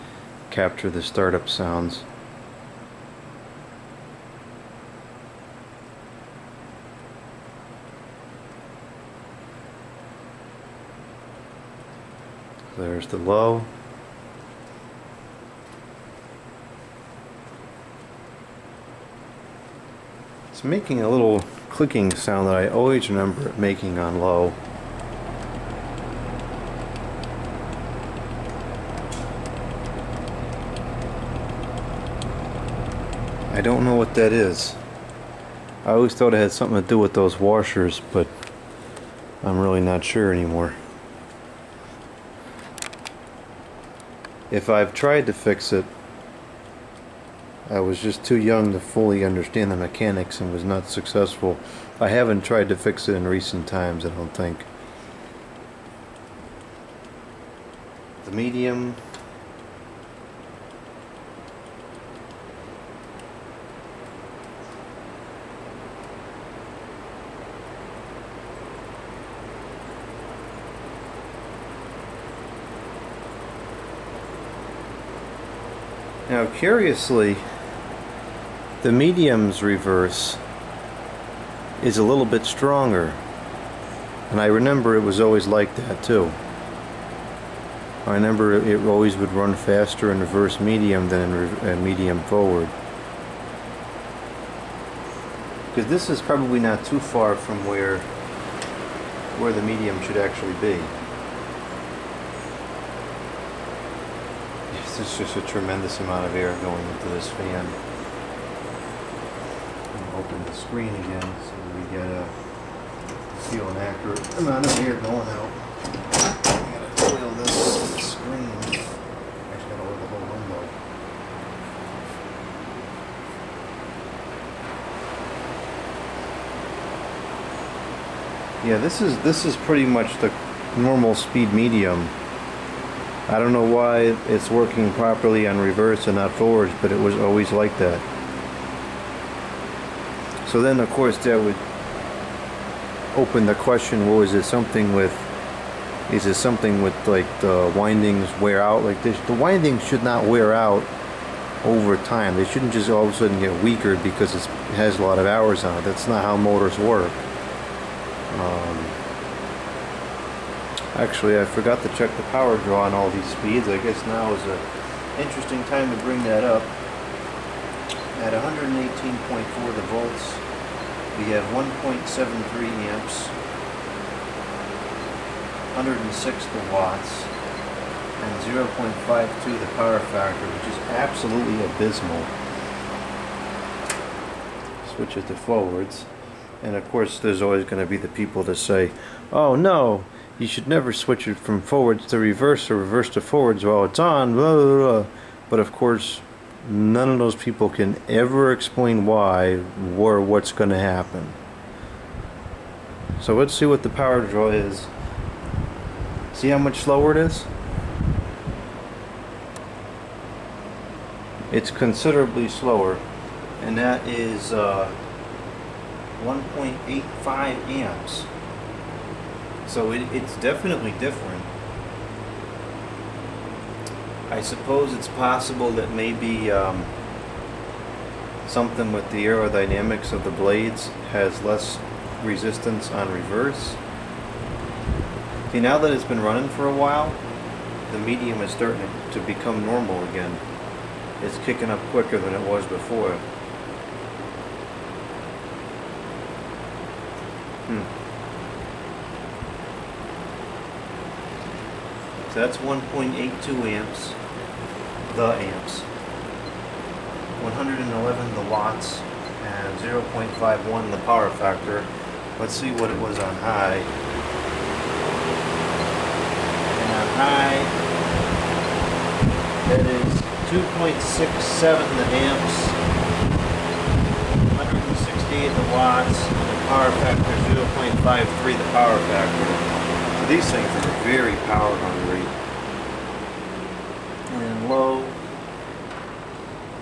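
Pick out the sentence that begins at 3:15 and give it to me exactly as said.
But of course, none of those people can ever explain why or what's going to happen.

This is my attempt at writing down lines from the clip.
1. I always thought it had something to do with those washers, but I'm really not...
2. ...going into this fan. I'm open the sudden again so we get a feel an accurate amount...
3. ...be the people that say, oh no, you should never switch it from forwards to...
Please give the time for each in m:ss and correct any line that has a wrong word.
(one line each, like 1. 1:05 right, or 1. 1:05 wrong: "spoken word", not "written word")
1. 0:35 right
2. 1:46 wrong: "screen", not "sudden"
3. 3:07 right.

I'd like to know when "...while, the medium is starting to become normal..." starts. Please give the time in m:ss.
3:56.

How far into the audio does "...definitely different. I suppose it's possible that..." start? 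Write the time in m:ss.
3:40.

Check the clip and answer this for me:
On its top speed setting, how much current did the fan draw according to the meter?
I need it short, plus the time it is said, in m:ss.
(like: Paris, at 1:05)
2.67 amps, at 4:30.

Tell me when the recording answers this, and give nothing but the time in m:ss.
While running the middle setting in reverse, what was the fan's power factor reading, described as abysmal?
2:58.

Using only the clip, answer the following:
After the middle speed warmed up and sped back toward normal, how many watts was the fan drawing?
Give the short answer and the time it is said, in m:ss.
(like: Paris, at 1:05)
111 watts, at 4:17.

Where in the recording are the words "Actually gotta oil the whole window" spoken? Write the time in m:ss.
1:58.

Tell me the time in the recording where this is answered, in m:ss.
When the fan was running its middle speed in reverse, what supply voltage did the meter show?
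2:48.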